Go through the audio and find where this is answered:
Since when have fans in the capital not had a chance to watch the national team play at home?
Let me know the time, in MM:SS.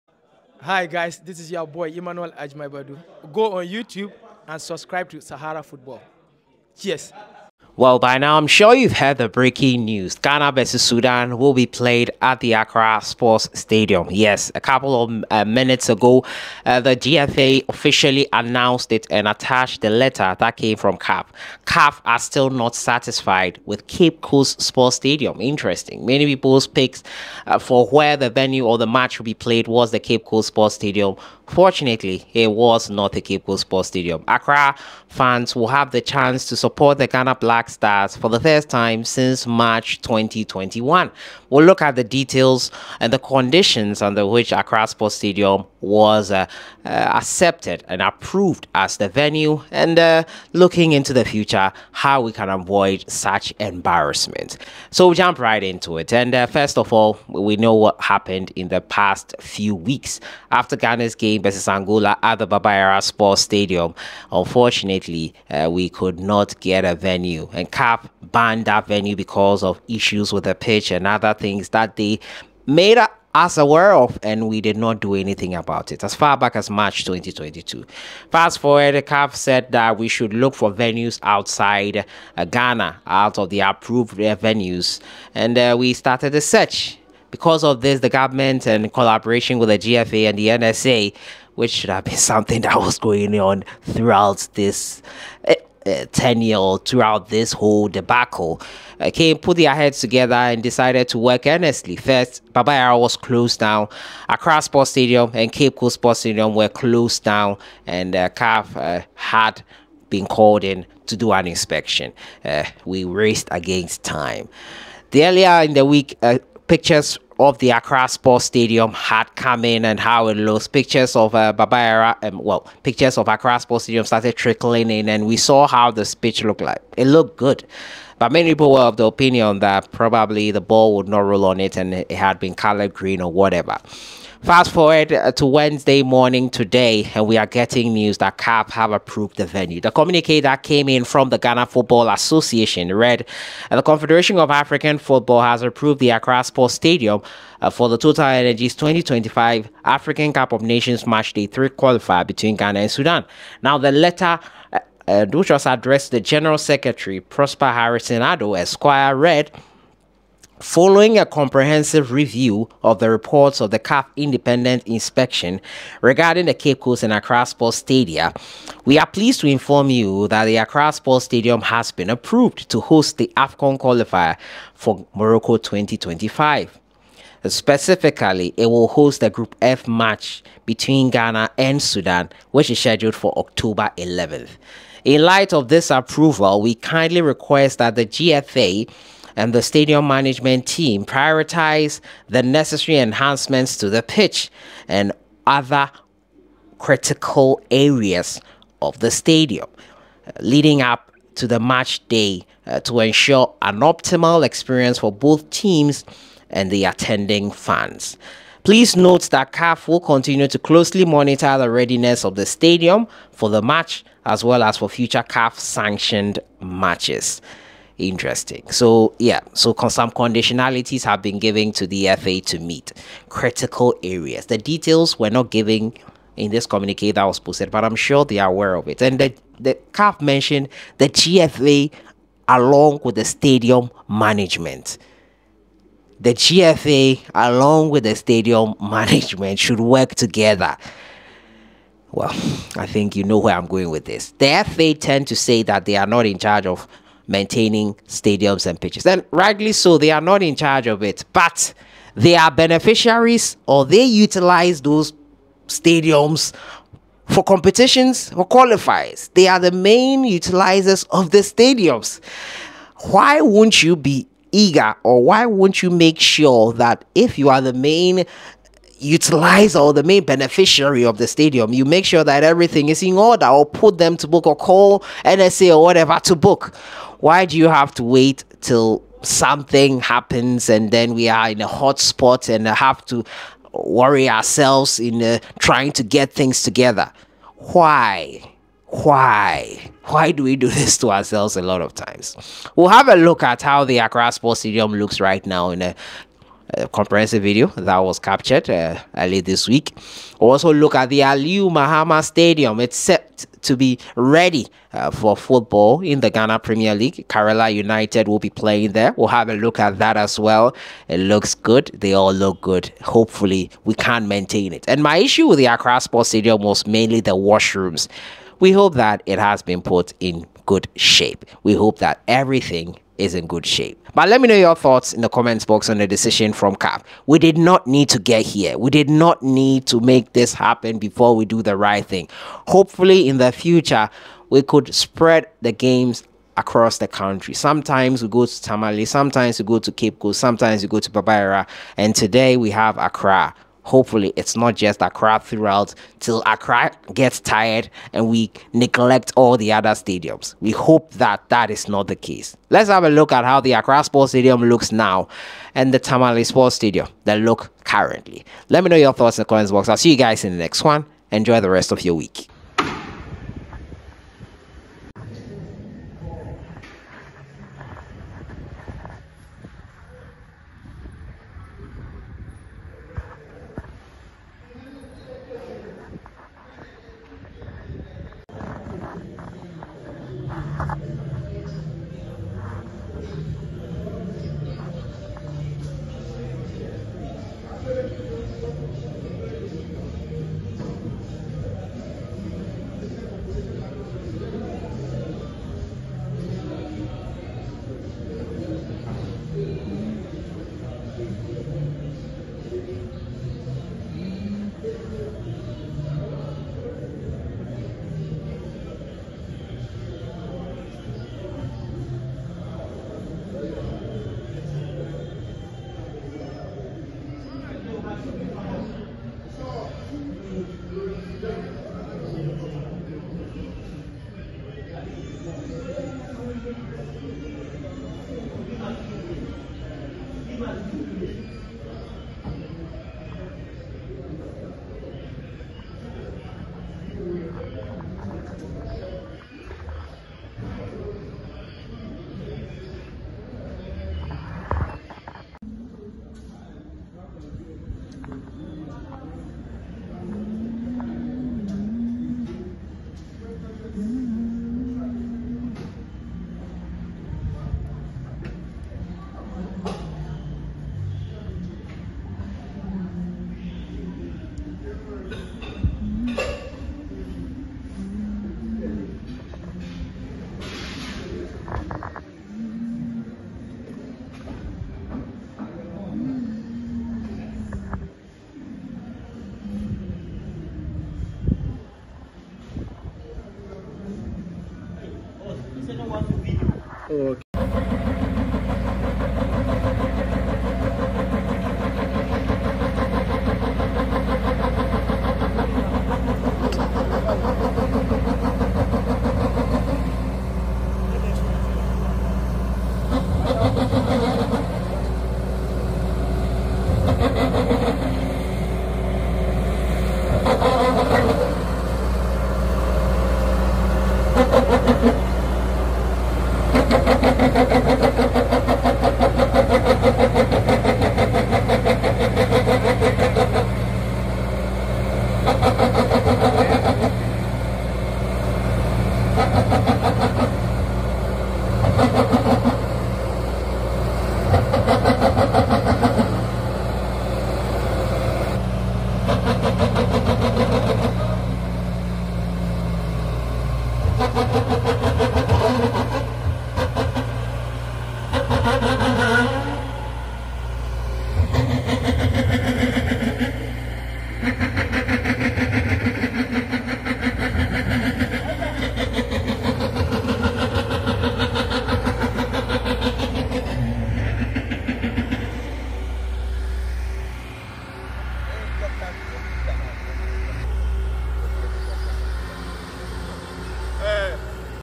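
00:39.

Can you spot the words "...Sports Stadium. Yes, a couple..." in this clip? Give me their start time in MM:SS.
00:13.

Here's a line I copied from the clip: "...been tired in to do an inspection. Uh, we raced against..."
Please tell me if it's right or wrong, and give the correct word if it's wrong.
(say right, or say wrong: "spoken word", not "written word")
wrong: "called", not "tired".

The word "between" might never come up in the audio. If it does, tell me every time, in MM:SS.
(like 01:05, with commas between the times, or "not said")
02:32, 03:00.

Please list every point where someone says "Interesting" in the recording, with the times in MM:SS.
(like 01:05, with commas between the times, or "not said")
00:25, 03:38.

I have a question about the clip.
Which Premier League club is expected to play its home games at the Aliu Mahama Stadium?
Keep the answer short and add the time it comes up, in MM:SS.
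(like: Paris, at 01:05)
Karela United, at 05:07.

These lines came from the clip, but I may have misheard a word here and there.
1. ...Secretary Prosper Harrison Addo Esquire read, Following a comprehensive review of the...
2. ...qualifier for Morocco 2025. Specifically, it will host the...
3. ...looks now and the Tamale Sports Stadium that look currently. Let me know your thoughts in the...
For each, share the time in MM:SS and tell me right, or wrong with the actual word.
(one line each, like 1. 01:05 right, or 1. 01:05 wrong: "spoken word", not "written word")
1. 02:36 right
2. 02:53 right
3. 05:54 right.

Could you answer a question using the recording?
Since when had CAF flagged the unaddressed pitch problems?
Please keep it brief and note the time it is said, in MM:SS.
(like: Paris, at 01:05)
March 2022, at 01:16.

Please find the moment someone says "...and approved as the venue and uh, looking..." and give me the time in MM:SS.
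00:47.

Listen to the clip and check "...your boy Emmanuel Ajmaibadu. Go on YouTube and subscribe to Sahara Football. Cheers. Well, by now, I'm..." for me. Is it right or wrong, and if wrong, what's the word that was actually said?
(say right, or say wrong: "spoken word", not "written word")
right.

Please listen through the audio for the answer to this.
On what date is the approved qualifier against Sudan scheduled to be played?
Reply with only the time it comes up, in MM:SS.
03:03.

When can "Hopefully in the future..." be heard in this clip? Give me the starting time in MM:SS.
05:32.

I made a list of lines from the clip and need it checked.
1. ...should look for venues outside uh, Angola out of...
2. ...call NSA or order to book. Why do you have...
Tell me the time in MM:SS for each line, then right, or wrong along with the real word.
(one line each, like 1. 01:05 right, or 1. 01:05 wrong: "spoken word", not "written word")
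1. 01:20 wrong: "Ghana", not "Angola"
2. 04:34 wrong: "whatever", not "order".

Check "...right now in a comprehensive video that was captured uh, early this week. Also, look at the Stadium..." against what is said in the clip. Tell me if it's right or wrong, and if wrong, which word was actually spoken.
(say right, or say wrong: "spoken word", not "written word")
wrong: "Aliu", not "Stadium".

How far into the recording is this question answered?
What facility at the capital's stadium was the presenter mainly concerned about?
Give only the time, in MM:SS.
05:17.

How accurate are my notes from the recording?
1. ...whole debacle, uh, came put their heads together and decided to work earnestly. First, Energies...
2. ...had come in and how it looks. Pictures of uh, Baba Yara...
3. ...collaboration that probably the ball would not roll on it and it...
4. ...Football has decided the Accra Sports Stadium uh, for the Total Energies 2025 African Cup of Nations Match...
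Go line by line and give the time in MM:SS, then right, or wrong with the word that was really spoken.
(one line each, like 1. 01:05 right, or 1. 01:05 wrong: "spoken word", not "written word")
1. 01:37 wrong: "Baba", not "Energies"
2. 01:58 right
3. 02:09 wrong: "opinion", not "collaboration"
4. 02:24 wrong: "approved", not "decided".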